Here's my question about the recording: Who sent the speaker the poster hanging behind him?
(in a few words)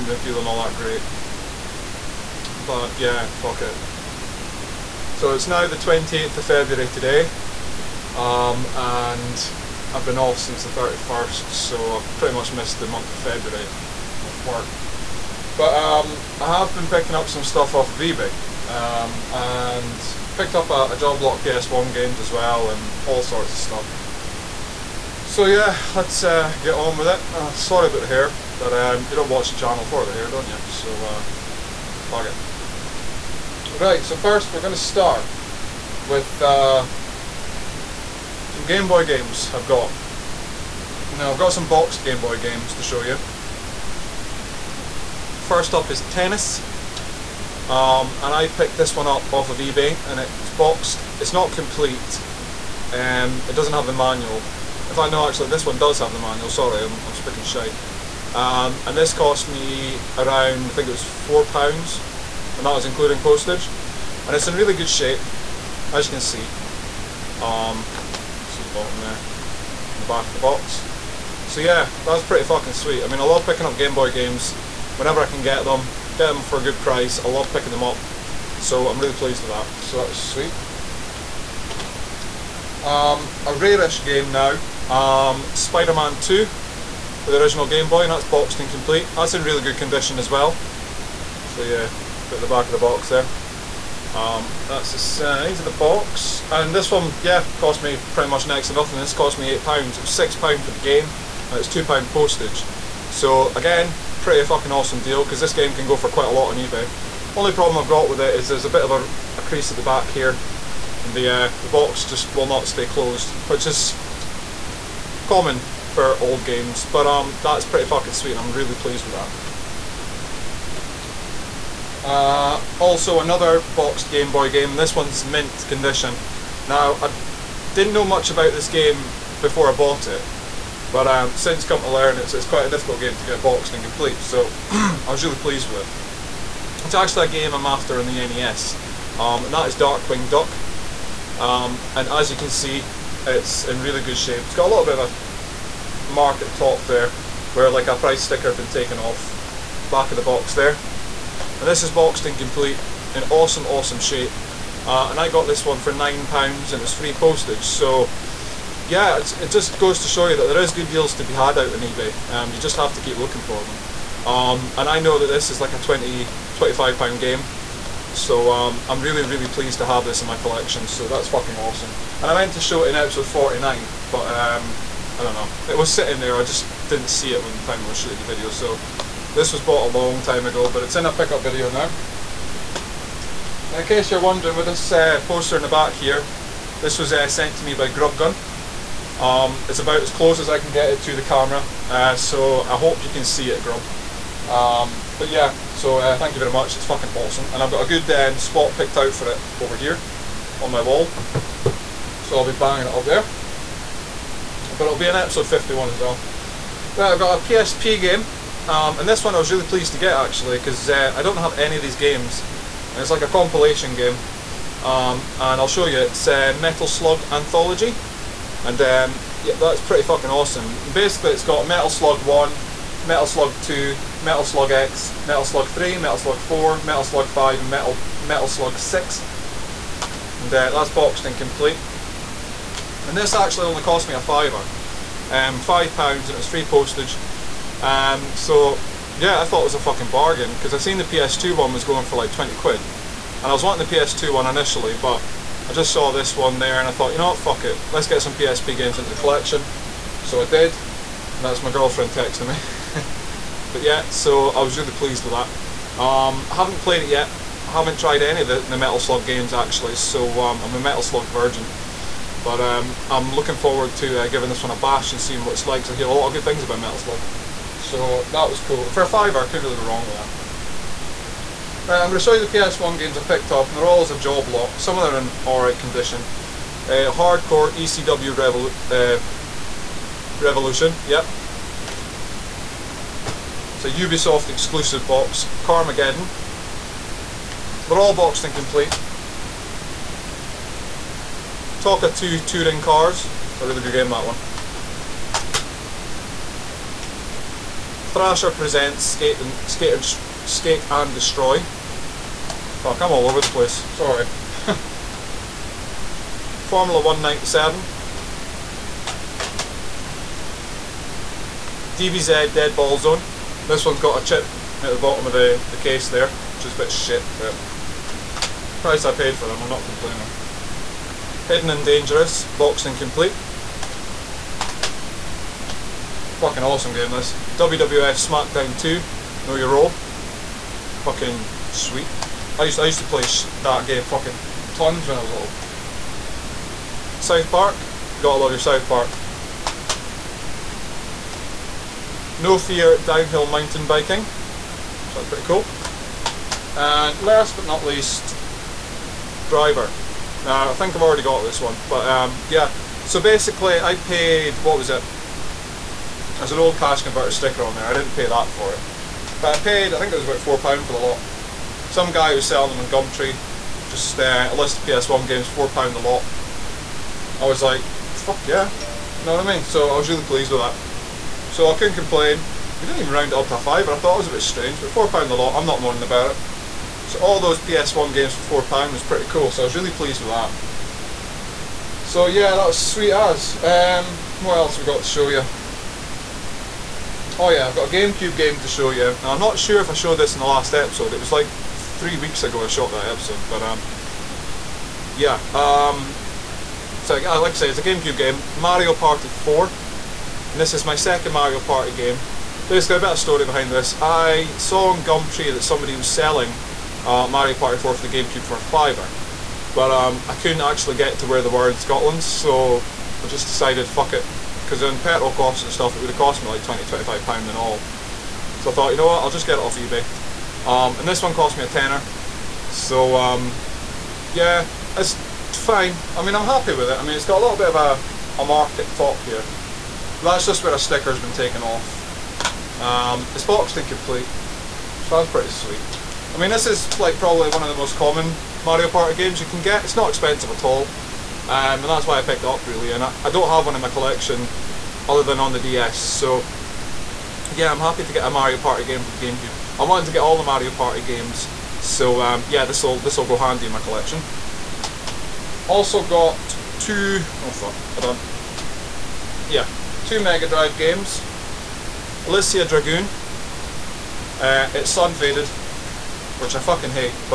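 Grubgun.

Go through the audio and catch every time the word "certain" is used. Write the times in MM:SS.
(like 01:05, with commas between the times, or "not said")
not said.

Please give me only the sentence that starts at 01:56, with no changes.
But um, that's pretty fucking sweet, and I'm really pleased with that.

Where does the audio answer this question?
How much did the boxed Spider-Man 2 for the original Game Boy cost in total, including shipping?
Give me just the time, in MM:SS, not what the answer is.
01:38.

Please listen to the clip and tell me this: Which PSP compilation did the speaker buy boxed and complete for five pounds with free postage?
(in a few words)
Metal Slug Anthology.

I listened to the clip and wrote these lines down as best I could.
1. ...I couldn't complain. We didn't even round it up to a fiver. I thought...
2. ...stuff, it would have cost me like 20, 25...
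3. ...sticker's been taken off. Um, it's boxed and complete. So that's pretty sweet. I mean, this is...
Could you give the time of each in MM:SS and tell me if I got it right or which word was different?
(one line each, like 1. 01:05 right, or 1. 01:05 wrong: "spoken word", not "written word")
1. 06:11 right
2. 06:55 right
3. 07:10 right.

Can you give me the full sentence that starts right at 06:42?
Basically, a bit of story behind this.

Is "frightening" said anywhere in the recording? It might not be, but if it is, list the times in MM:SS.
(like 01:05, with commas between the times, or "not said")
not said.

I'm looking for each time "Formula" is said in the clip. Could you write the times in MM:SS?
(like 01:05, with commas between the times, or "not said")
05:06.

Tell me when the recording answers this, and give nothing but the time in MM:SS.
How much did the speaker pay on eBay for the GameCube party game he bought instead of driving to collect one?
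07:01.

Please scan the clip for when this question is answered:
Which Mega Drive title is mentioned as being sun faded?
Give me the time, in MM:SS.
07:42.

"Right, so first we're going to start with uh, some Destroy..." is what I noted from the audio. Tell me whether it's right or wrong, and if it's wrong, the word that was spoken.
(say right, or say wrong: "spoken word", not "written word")
wrong: "Game", not "Destroy".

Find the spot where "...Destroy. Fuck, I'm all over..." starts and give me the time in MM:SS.
05:01.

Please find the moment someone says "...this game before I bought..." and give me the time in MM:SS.
02:08.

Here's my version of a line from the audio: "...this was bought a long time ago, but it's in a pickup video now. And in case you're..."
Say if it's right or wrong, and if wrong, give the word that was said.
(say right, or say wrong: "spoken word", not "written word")
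right.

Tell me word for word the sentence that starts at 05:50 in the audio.
Now, I think I've already got this one, but um, yeah.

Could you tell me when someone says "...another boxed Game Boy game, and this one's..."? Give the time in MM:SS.
02:03.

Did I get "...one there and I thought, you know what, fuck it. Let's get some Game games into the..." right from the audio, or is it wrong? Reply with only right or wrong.
wrong.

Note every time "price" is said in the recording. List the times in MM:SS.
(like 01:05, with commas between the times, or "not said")
01:16, 02:27, 05:18.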